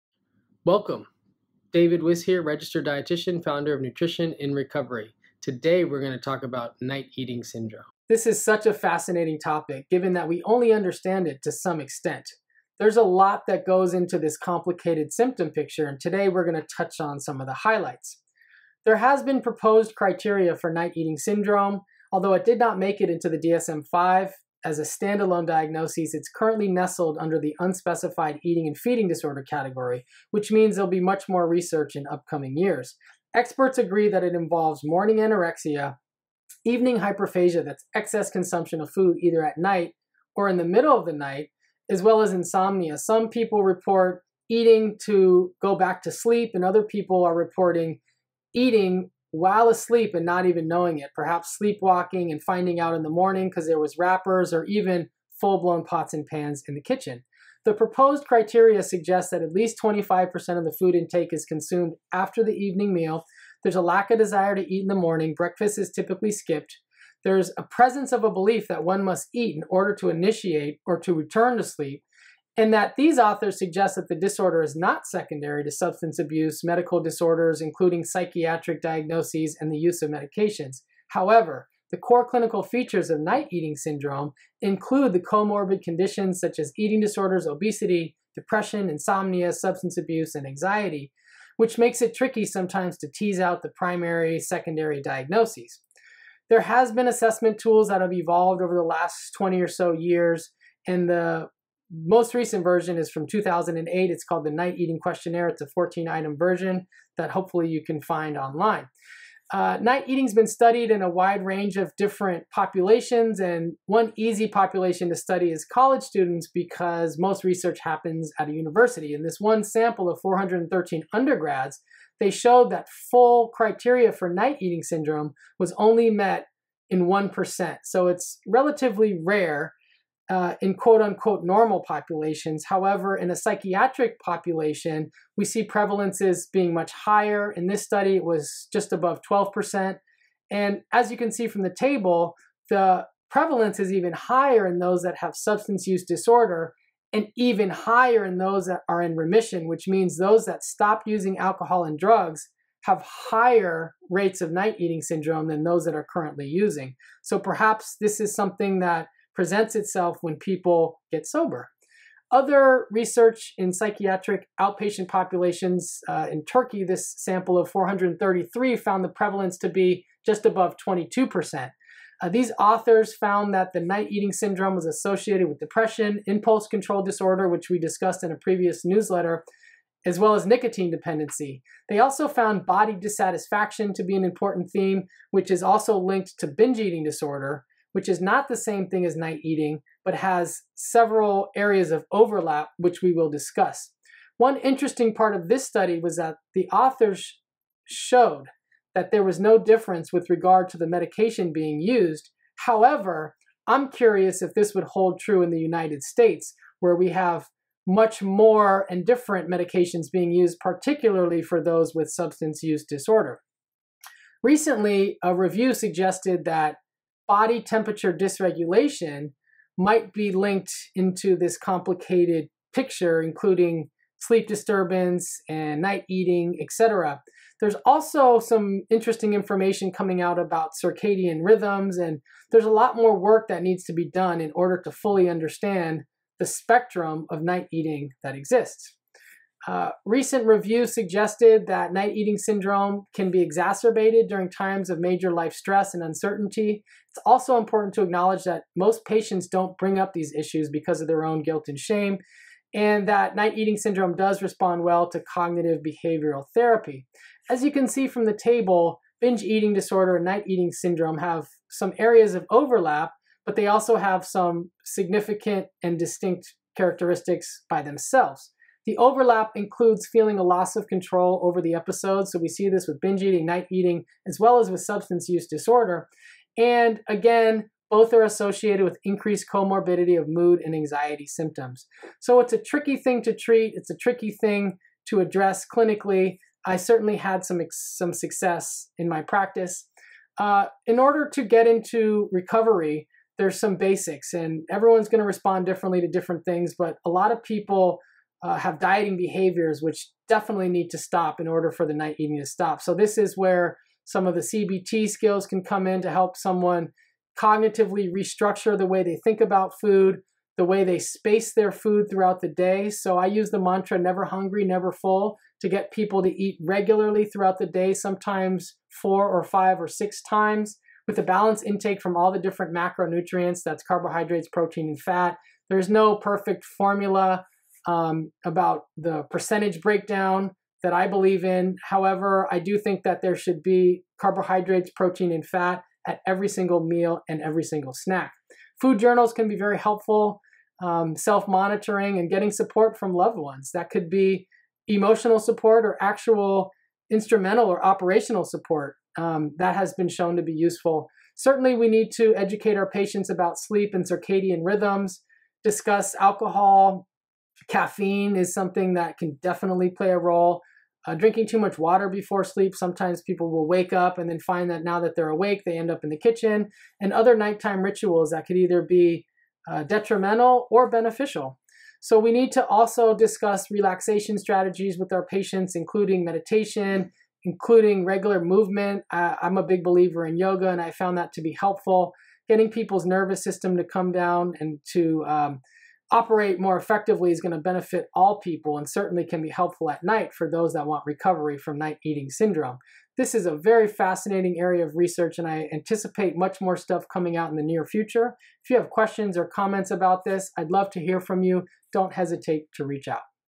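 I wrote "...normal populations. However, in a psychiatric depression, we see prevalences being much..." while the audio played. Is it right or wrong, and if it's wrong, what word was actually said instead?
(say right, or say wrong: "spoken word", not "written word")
wrong: "population", not "depression".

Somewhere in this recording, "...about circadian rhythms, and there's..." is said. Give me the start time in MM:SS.
03:50.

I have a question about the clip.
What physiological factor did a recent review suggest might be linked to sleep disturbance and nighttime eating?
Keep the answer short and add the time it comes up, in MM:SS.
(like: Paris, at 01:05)
Body temperature dysregulation, at 03:37.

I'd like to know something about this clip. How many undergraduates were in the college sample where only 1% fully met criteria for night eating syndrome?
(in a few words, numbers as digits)
413.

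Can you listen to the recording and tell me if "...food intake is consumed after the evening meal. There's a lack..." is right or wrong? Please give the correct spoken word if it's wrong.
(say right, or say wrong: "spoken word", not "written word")
right.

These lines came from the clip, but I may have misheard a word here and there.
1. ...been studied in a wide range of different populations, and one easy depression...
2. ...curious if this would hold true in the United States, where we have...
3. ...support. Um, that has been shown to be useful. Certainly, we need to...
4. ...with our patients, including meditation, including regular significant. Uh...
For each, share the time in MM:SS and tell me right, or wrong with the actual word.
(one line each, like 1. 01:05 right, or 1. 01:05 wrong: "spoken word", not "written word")
1. 01:50 wrong: "population", not "depression"
2. 03:23 right
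3. 05:48 right
4. 06:14 wrong: "movement", not "significant".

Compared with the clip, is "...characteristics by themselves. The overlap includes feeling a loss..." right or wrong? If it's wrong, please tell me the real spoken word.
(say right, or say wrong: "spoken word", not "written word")
right.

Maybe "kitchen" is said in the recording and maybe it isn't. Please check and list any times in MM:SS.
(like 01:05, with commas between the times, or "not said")
00:56, 06:06.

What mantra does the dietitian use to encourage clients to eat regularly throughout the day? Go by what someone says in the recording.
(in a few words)
Never hungry, never full.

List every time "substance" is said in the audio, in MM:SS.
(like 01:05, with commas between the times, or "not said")
01:15, 01:29, 02:25, 03:32, 04:34.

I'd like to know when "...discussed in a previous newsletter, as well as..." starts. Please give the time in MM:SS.
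02:57.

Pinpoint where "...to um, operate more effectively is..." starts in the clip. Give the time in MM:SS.
06:24.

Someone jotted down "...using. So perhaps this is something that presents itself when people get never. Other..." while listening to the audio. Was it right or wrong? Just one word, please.
wrong.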